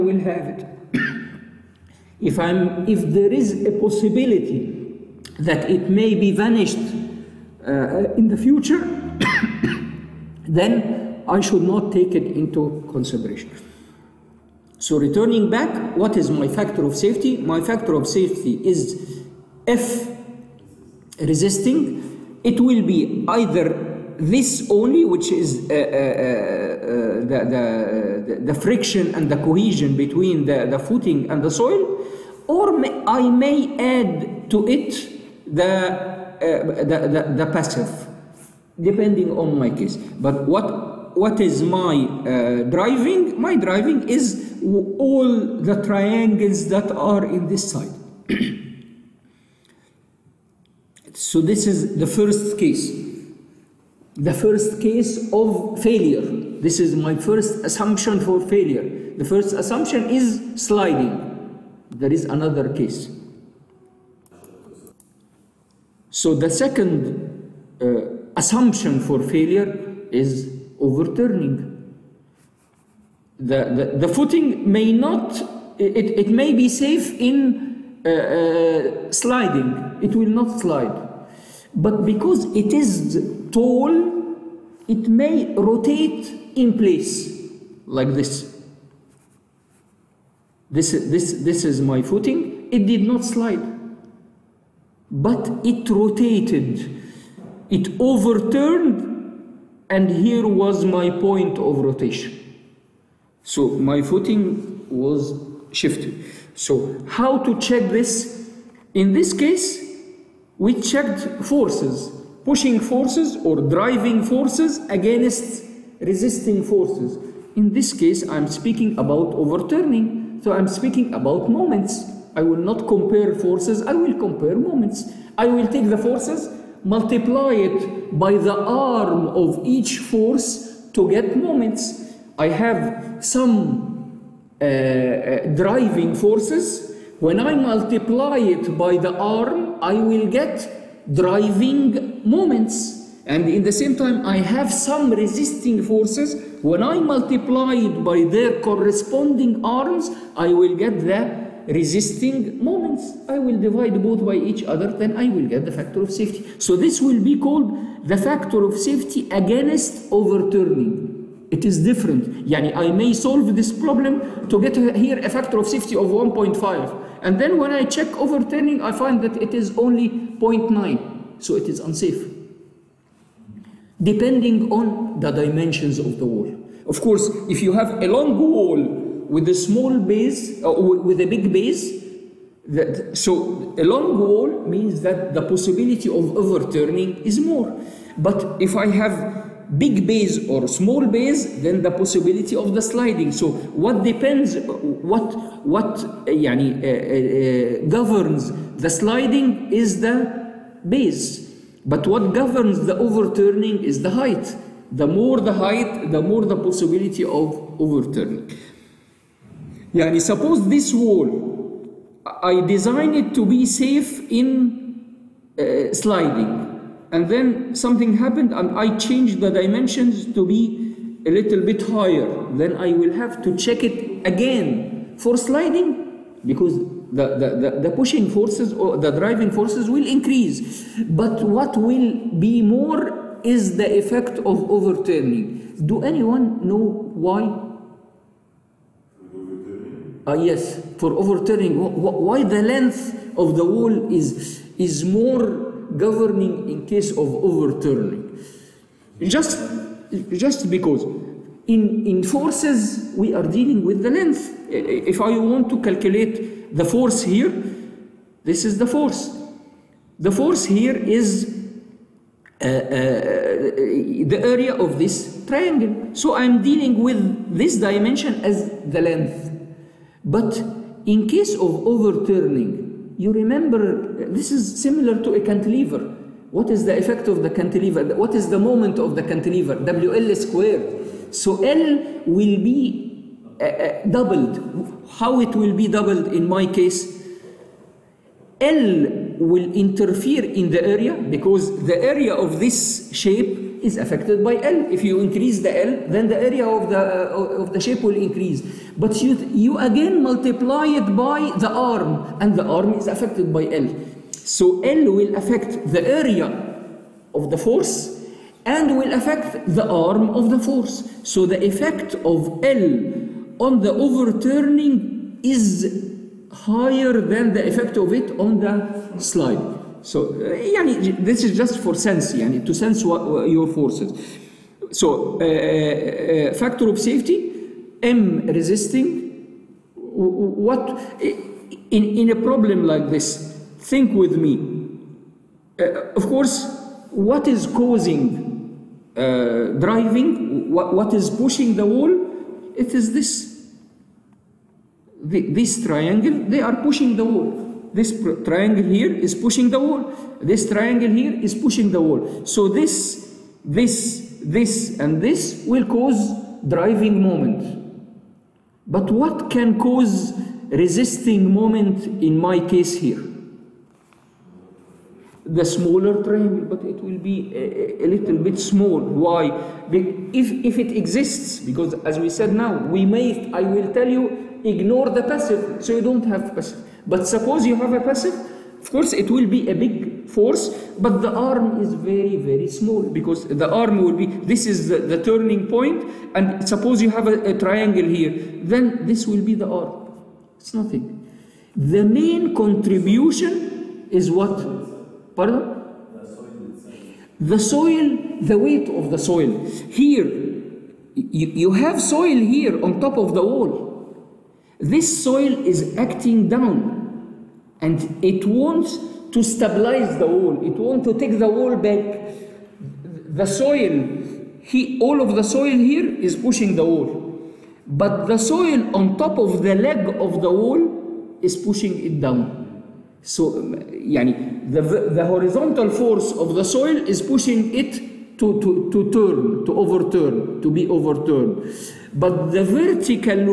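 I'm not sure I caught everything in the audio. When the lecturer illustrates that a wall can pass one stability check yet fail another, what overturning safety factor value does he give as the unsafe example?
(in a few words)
0.9.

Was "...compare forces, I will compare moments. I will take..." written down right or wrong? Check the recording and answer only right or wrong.
right.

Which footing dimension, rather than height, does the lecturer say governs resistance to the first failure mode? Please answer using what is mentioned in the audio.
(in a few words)
The base.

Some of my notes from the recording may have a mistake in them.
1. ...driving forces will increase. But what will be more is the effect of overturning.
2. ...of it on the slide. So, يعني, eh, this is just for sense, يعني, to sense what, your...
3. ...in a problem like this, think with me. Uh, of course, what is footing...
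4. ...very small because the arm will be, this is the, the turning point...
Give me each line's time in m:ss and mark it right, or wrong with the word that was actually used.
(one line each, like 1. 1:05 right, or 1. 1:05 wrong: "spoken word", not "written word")
1. 3:49 right
2. 5:17 right
3. 5:32 wrong: "causing", not "footing"
4. 6:22 right.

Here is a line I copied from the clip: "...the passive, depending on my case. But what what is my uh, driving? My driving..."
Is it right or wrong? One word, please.
right.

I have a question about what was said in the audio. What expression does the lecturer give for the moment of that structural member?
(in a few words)
WL squared.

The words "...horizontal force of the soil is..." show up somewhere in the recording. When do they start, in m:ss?
7:05.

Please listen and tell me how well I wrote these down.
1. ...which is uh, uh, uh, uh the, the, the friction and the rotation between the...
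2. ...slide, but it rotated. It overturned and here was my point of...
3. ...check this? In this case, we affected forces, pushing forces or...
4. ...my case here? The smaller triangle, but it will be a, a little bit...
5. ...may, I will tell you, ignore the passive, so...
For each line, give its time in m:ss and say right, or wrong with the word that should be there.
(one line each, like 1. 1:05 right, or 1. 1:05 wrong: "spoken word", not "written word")
1. 0:25 wrong: "cohesion", not "rotation"
2. 1:33 right
3. 1:47 wrong: "checked", not "affected"
4. 6:02 right
5. 6:13 right.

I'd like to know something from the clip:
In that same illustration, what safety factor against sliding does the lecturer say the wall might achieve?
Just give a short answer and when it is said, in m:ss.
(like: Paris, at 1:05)
1.5, at 2:46.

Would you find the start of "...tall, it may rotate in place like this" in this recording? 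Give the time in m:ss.
1:23.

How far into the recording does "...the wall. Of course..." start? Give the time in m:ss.
2:56.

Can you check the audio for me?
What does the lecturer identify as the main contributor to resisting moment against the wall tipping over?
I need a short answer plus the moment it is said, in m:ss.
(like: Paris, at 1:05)
Weight of the soil, at 6:38.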